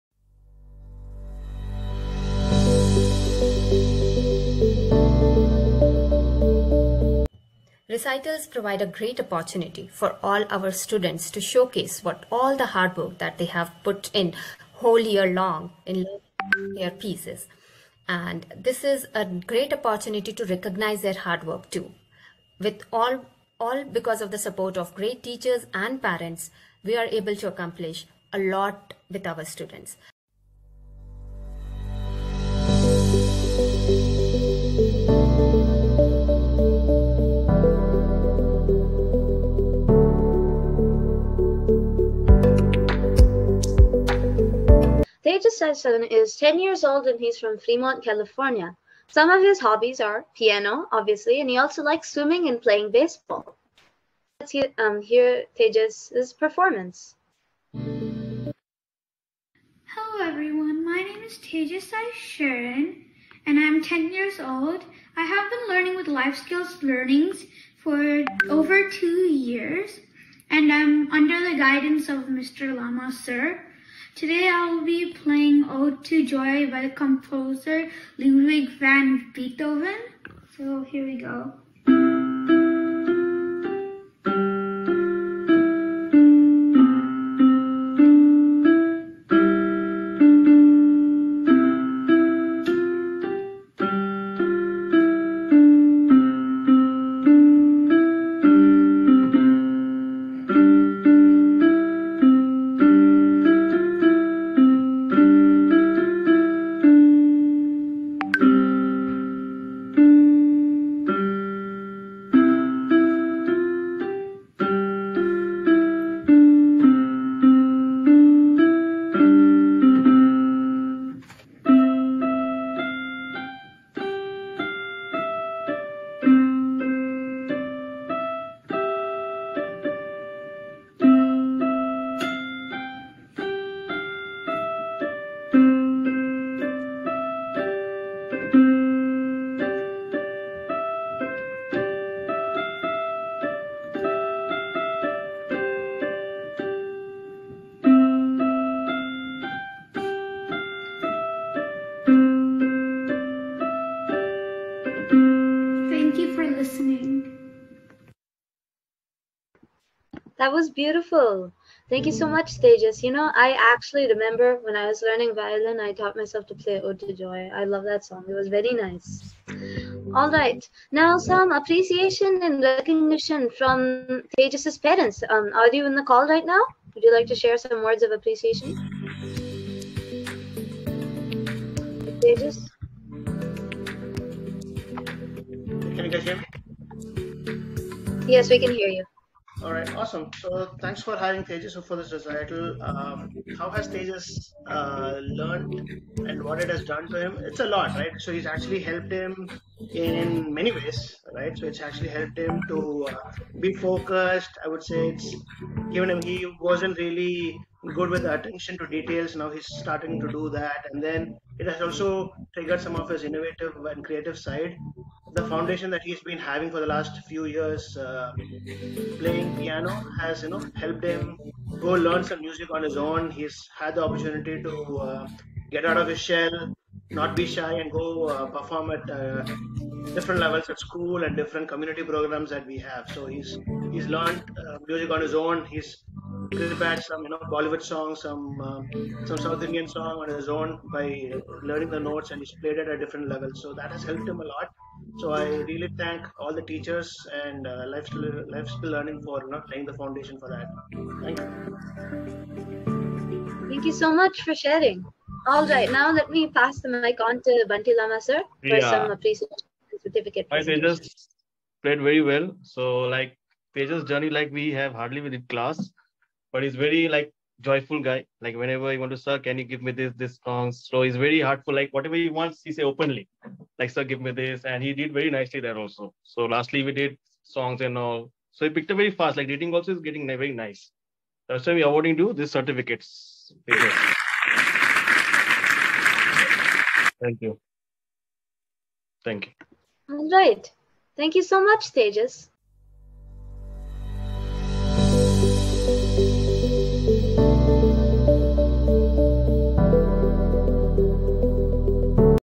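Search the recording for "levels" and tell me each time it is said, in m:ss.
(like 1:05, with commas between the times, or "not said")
3:50, 4:03.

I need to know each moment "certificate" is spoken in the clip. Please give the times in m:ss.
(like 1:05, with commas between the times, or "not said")
4:20, 4:42.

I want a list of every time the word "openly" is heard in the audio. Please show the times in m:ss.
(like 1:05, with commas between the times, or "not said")
4:32.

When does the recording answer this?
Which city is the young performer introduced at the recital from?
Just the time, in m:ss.
0:47.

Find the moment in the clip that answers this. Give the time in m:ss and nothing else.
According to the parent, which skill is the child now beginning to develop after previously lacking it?
3:28.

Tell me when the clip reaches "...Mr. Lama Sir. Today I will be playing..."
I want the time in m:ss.
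1:12.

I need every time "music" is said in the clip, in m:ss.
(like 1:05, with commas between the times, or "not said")
3:42, 3:54.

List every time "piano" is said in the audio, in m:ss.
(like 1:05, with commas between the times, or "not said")
0:50, 3:39.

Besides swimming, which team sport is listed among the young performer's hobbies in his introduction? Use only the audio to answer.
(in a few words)
baseball.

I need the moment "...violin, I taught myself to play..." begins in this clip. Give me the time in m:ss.
2:45.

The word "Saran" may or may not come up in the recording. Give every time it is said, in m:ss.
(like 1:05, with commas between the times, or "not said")
1:01.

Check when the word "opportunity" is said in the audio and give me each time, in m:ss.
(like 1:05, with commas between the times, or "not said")
0:09, 0:19, 3:44.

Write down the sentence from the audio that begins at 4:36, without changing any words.
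So lastly, we did songs and all.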